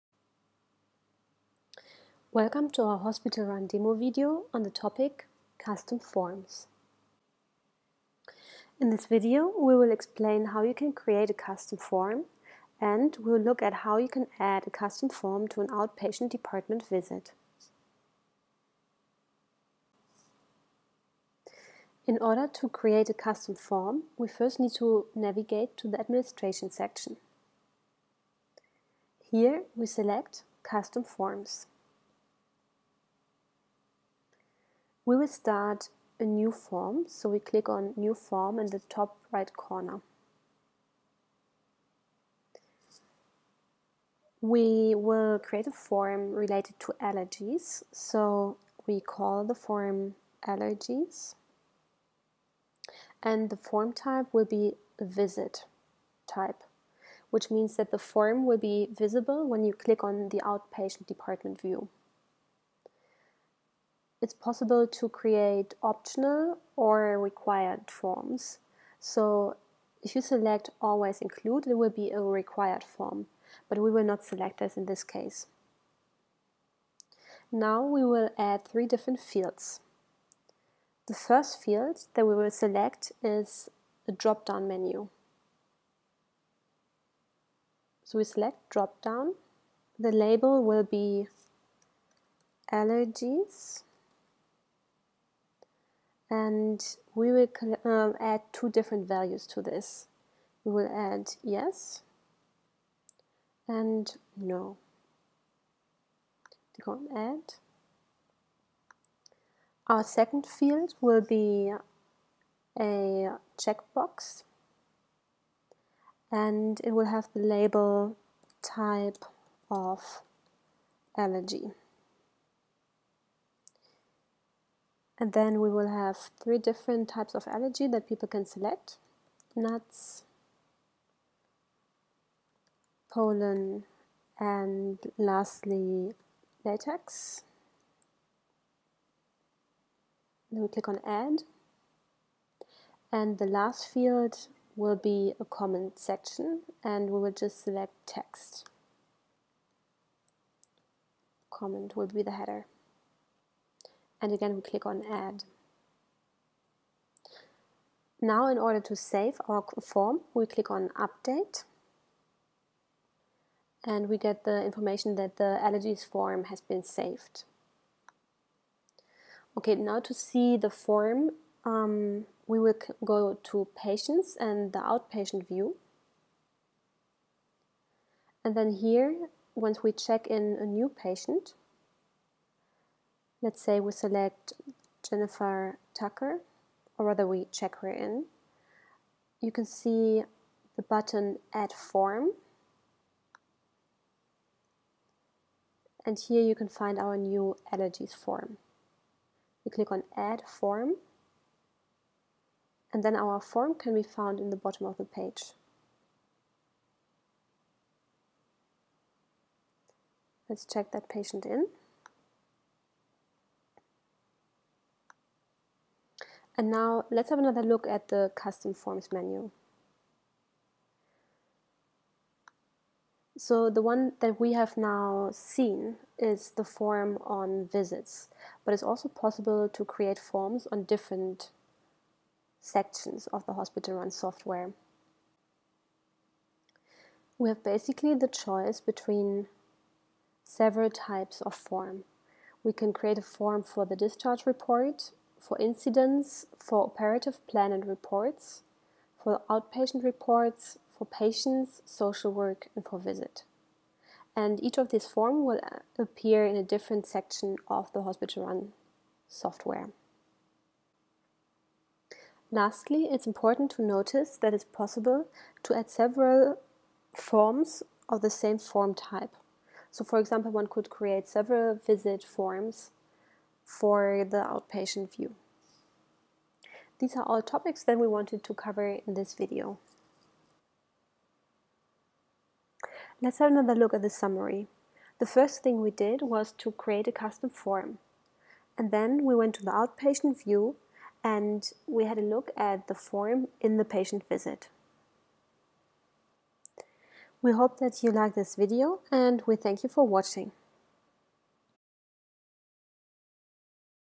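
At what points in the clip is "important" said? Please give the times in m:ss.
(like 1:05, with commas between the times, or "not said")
4:23.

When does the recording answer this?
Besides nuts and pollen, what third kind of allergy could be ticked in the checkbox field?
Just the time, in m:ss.
2:16.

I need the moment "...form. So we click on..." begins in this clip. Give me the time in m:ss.
0:36.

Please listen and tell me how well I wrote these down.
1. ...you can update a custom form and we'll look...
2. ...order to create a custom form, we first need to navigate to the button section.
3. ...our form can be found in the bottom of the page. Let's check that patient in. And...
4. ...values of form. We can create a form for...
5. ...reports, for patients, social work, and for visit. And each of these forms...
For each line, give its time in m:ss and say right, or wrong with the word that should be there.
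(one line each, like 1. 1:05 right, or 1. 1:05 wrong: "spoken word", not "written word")
1. 0:10 wrong: "create", not "update"
2. 0:22 wrong: "administration", not "button"
3. 3:23 right
4. 4:00 wrong: "types", not "values"
5. 4:10 right.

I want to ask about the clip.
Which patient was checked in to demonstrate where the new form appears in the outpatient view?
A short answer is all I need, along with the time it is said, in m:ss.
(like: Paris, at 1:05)
Jennifer Tucker, at 3:05.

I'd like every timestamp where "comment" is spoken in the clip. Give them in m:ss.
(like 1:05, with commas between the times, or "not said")
2:25, 2:31.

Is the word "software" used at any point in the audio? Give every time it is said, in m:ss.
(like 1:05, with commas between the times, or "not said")
3:54, 4:19.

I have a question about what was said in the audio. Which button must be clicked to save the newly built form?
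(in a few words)
Update.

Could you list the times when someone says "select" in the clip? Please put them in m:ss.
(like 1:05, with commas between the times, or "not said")
0:29, 1:10, 1:14, 1:22, 1:28, 2:08, 2:27, 3:03.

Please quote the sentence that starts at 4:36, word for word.
These are all topics that we wanted to cover in this video.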